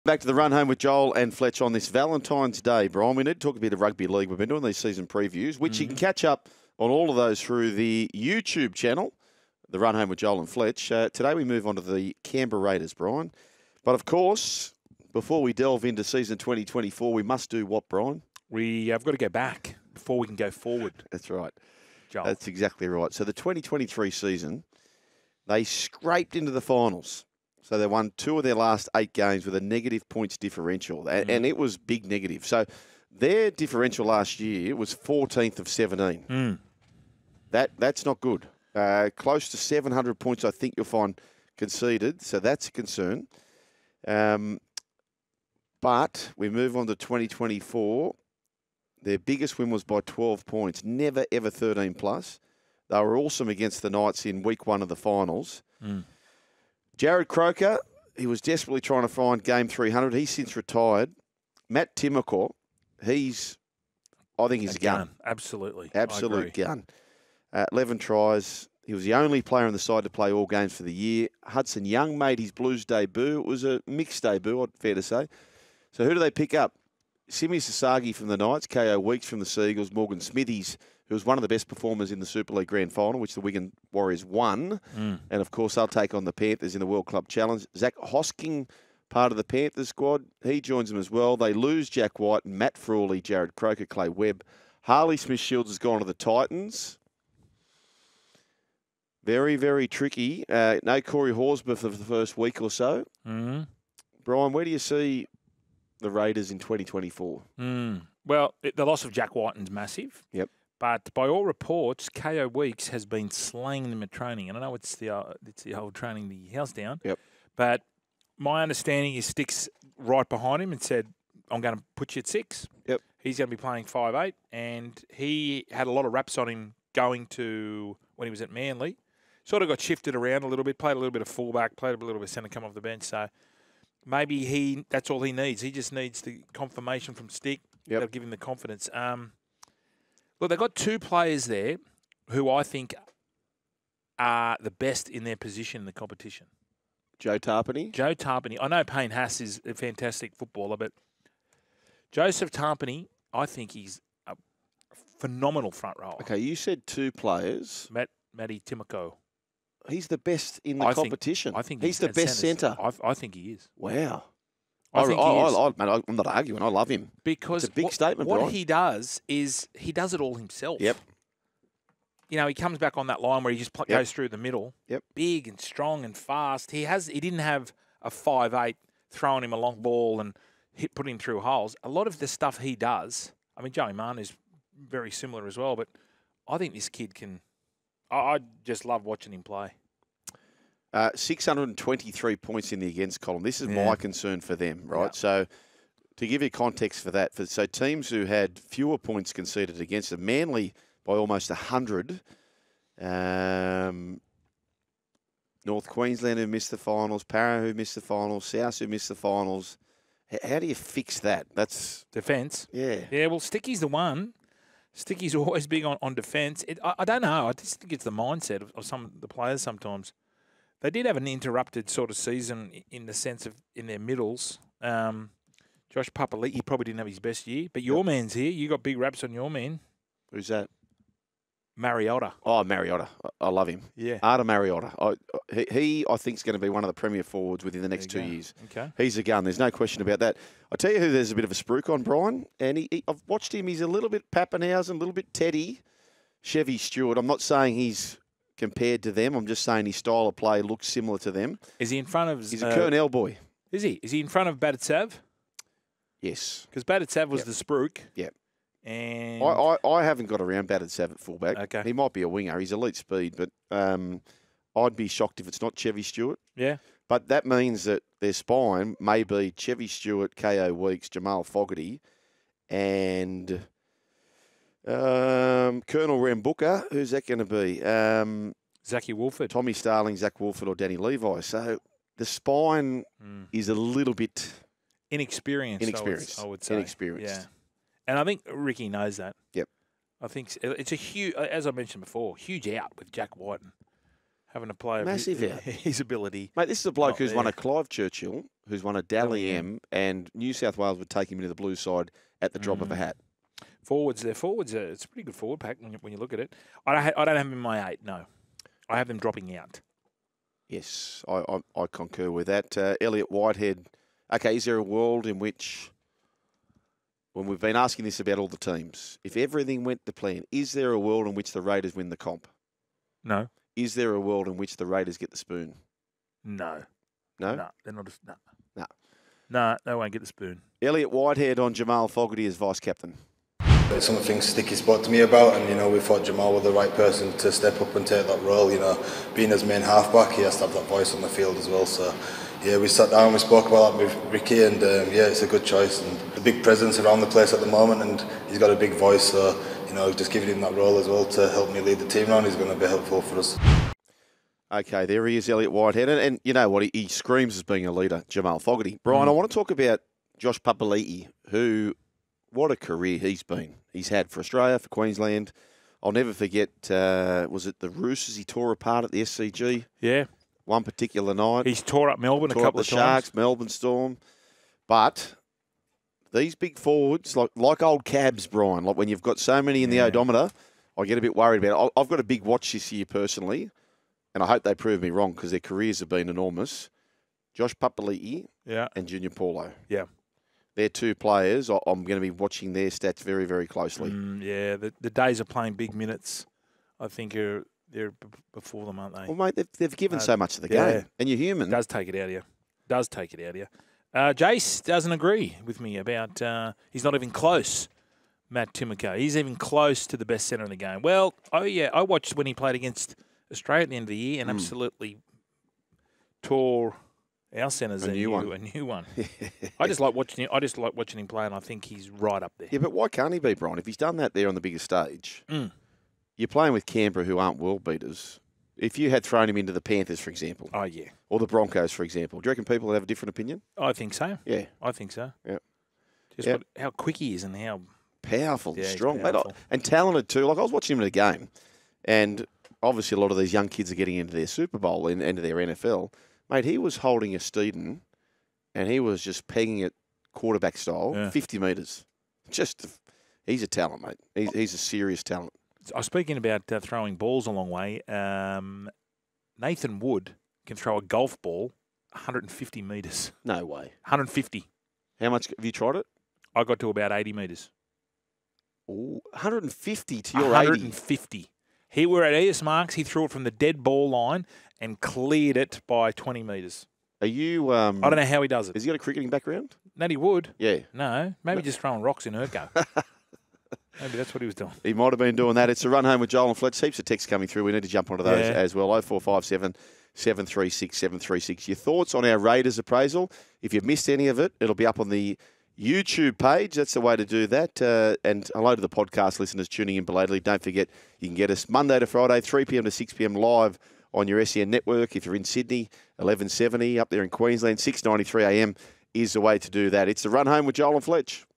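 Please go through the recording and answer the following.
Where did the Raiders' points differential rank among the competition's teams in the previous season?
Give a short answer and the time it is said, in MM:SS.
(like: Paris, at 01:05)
14th of 17, at 00:34.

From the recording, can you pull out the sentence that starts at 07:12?
Do you reckon people would have a different opinion?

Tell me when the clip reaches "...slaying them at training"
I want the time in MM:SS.
01:53.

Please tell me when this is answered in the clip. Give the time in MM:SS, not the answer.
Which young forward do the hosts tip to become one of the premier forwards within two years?
03:54.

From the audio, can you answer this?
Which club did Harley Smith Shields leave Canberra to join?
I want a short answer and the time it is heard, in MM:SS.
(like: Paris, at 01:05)
Titans, at 01:36.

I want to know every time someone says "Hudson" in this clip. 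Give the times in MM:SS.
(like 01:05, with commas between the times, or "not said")
01:11.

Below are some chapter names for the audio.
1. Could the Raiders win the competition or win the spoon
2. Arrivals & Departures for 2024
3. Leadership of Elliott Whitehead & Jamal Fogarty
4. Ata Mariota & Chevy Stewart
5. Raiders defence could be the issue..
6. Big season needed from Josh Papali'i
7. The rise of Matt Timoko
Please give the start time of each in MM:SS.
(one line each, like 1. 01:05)
1. 04:50
2. 00:35
3. 05:10
4. 03:40
5. 03:00
6. 05:40
7. 00:50.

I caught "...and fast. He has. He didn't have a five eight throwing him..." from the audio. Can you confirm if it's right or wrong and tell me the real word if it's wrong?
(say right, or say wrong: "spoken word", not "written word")
right.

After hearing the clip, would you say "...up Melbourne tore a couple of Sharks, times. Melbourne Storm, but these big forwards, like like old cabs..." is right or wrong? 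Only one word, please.
right.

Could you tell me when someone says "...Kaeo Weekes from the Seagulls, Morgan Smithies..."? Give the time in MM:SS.
01:18.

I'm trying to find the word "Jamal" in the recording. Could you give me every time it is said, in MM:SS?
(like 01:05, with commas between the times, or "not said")
04:31, 05:31, 05:36, 05:58.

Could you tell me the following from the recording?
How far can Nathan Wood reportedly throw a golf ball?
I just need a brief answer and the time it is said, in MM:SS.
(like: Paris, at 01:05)
150 metres, at 07:42.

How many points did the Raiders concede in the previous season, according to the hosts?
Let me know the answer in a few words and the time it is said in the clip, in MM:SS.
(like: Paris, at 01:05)
623, at 03:11.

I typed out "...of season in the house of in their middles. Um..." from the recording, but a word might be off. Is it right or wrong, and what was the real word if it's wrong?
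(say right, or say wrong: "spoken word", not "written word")
wrong: "sense", not "house".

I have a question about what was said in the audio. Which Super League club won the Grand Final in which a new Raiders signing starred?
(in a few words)
Wigan Warriors.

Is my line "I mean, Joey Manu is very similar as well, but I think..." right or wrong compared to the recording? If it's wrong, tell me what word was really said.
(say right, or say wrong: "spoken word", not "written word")
right.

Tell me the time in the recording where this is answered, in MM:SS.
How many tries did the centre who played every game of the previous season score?
01:07.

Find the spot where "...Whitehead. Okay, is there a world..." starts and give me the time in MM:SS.
05:13.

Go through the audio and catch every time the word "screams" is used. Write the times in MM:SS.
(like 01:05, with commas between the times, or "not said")
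05:57.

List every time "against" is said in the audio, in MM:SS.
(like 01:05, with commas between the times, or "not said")
00:53, 03:12, 03:19, 06:52.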